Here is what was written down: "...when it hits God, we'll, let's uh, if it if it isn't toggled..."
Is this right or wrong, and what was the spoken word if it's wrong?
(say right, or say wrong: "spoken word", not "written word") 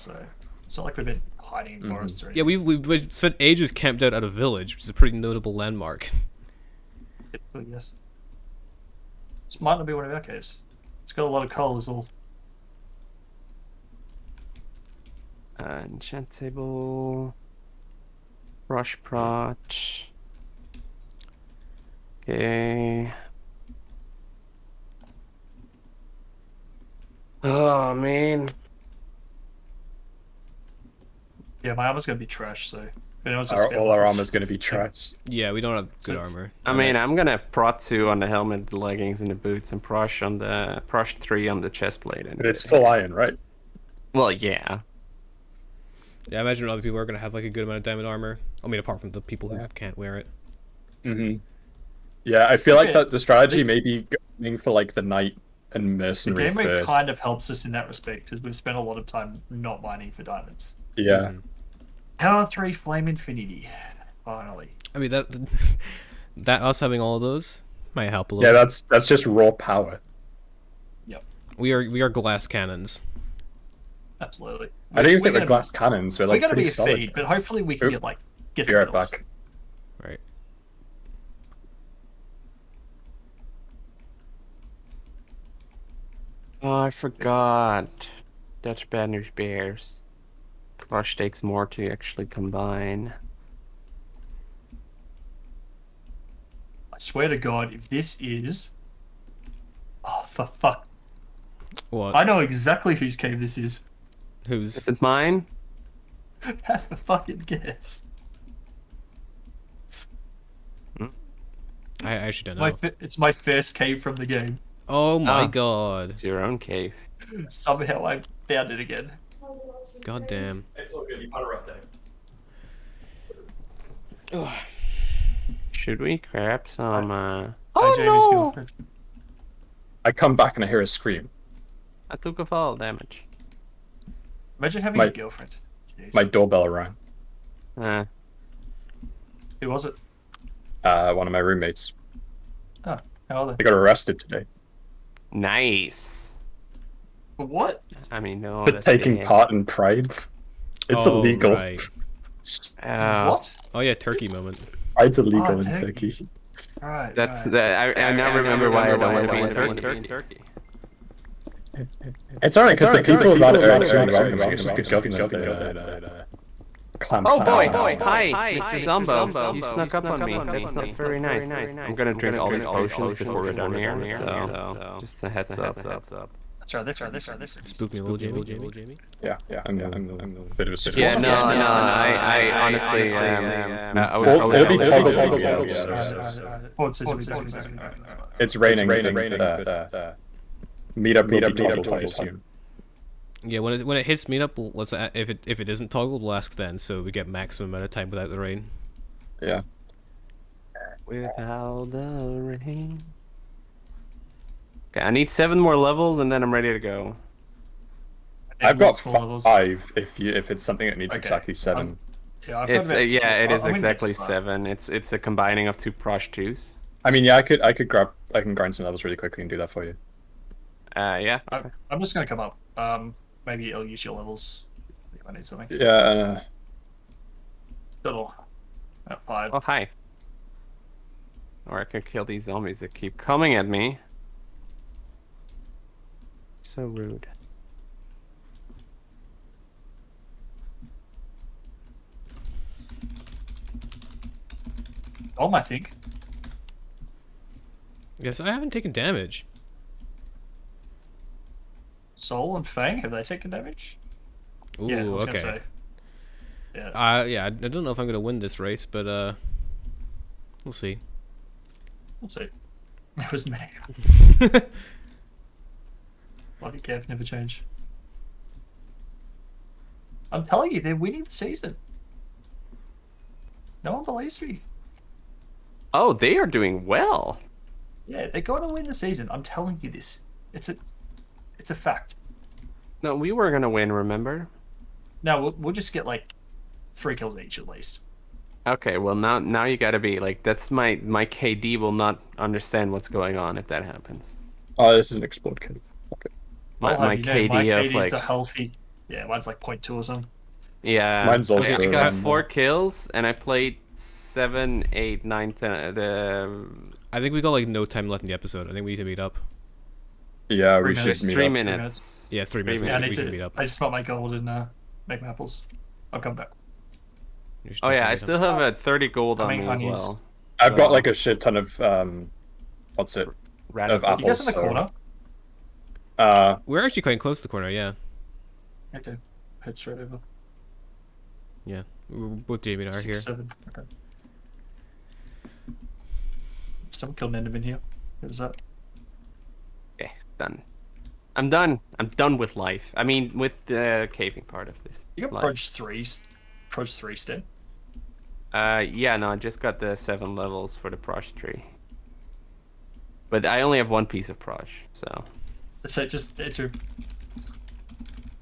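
wrong: "Meetup", not "God".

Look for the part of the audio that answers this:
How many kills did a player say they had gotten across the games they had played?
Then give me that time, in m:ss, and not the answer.
5:02.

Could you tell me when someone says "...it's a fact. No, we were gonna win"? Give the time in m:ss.
4:41.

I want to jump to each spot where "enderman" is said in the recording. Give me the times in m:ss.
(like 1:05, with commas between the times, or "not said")
5:37.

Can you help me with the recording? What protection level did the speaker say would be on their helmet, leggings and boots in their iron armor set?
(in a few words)
Prot 2.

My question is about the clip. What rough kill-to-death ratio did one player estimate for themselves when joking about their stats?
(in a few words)
0.2.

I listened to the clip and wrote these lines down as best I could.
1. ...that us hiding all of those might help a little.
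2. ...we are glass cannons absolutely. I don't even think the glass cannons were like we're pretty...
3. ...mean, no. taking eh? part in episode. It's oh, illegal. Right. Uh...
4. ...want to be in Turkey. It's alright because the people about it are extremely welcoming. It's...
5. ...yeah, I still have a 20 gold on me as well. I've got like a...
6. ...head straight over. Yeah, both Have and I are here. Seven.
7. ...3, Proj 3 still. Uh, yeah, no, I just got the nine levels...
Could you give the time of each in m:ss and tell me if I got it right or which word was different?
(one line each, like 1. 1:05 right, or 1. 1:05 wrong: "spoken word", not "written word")
1. 1:06 wrong: "having", not "hiding"
2. 1:11 right
3. 2:28 wrong: "pride", not "episode"
4. 2:39 right
5. 5:17 wrong: "30", not "20"
6. 5:29 wrong: "Jamie", not "Have"
7. 5:45 wrong: "seven", not "nine".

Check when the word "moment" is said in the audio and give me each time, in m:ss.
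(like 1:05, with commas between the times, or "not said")
2:34, 3:07.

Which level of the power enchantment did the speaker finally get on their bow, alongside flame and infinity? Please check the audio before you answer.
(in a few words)
Power 3.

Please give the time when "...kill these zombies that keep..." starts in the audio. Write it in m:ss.
3:52.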